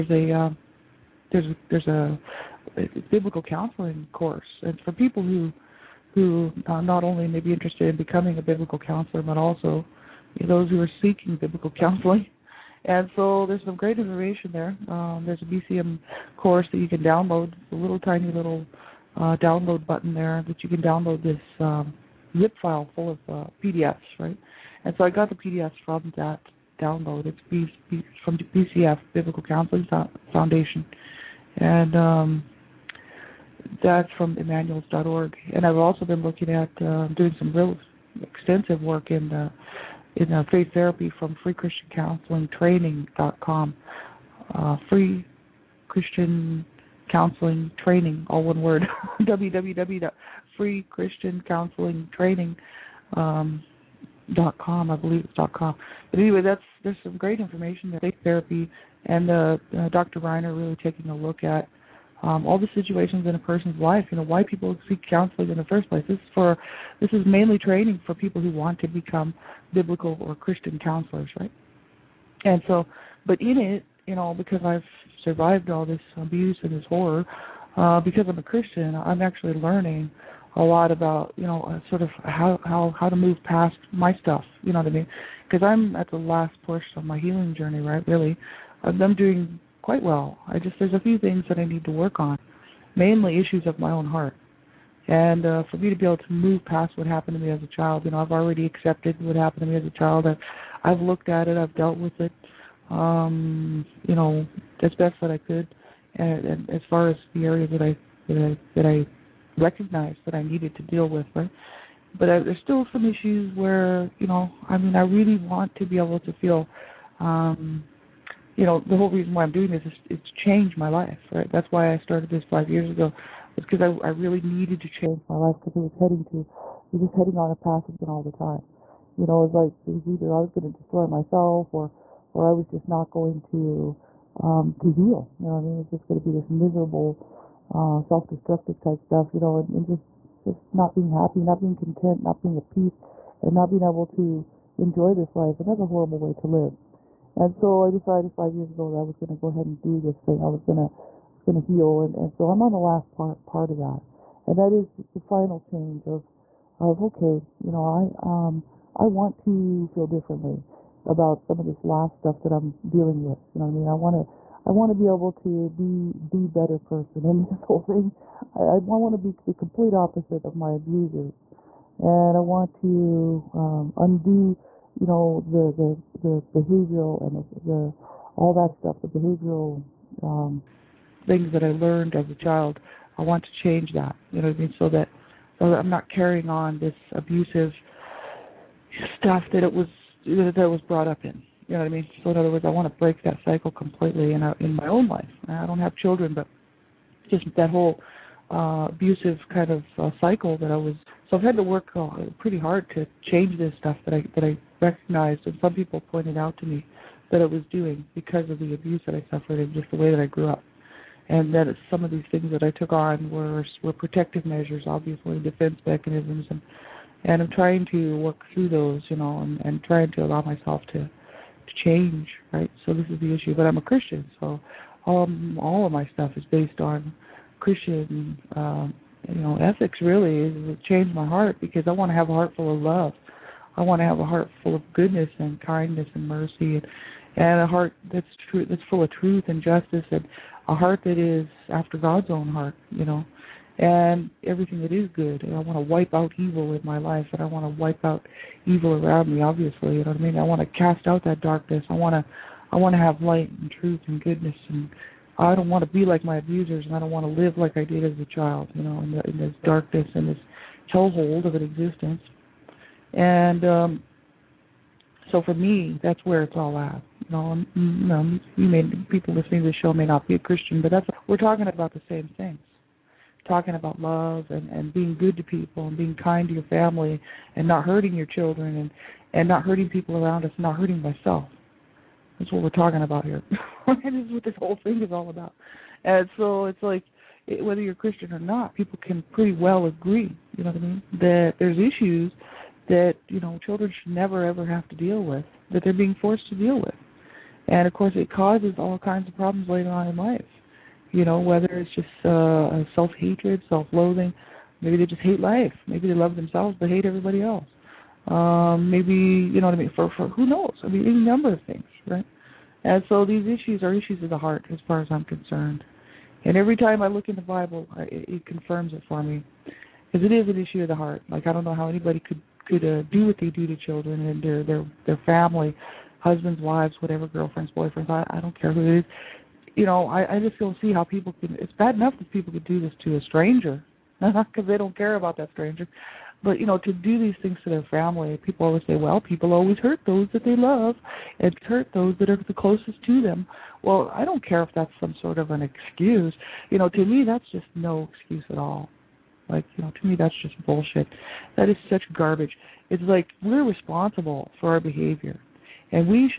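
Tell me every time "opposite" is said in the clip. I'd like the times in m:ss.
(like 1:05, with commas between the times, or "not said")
2:49.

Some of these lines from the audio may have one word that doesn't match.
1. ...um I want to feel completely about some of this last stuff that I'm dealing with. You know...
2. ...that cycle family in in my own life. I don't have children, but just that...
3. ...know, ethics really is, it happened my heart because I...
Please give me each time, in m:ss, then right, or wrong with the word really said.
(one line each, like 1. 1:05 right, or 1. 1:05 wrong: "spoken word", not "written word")
1. 2:38 wrong: "differently", not "completely"
2. 3:13 wrong: "completely", not "family"
3. 3:49 wrong: "changed", not "happened".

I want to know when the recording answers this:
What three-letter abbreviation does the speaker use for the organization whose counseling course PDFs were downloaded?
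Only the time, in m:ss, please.
0:28.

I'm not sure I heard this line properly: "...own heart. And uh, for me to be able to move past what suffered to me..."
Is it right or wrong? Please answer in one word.
wrong.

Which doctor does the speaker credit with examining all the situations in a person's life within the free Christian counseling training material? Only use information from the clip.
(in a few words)
Dr. Reiner.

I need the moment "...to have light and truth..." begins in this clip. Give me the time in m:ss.
4:12.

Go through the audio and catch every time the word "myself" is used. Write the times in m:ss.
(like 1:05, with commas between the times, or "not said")
2:11, 3:40, 4:41.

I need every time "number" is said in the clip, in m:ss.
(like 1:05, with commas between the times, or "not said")
5:11.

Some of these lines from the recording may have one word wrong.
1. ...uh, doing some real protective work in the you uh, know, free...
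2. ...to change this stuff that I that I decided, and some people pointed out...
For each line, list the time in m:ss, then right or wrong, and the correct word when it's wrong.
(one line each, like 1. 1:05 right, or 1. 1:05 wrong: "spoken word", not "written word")
1. 0:36 wrong: "extensive", not "protective"
2. 3:22 wrong: "recognized", not "decided".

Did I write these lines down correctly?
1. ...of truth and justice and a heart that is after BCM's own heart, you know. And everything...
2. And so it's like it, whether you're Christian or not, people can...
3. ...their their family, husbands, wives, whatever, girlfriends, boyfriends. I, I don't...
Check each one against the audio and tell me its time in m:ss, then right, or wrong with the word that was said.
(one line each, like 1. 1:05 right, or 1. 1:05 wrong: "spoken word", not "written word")
1. 3:59 wrong: "God", not "BCM"
2. 4:46 right
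3. 5:24 right.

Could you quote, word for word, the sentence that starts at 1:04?
You know why people seek counseling in the first place.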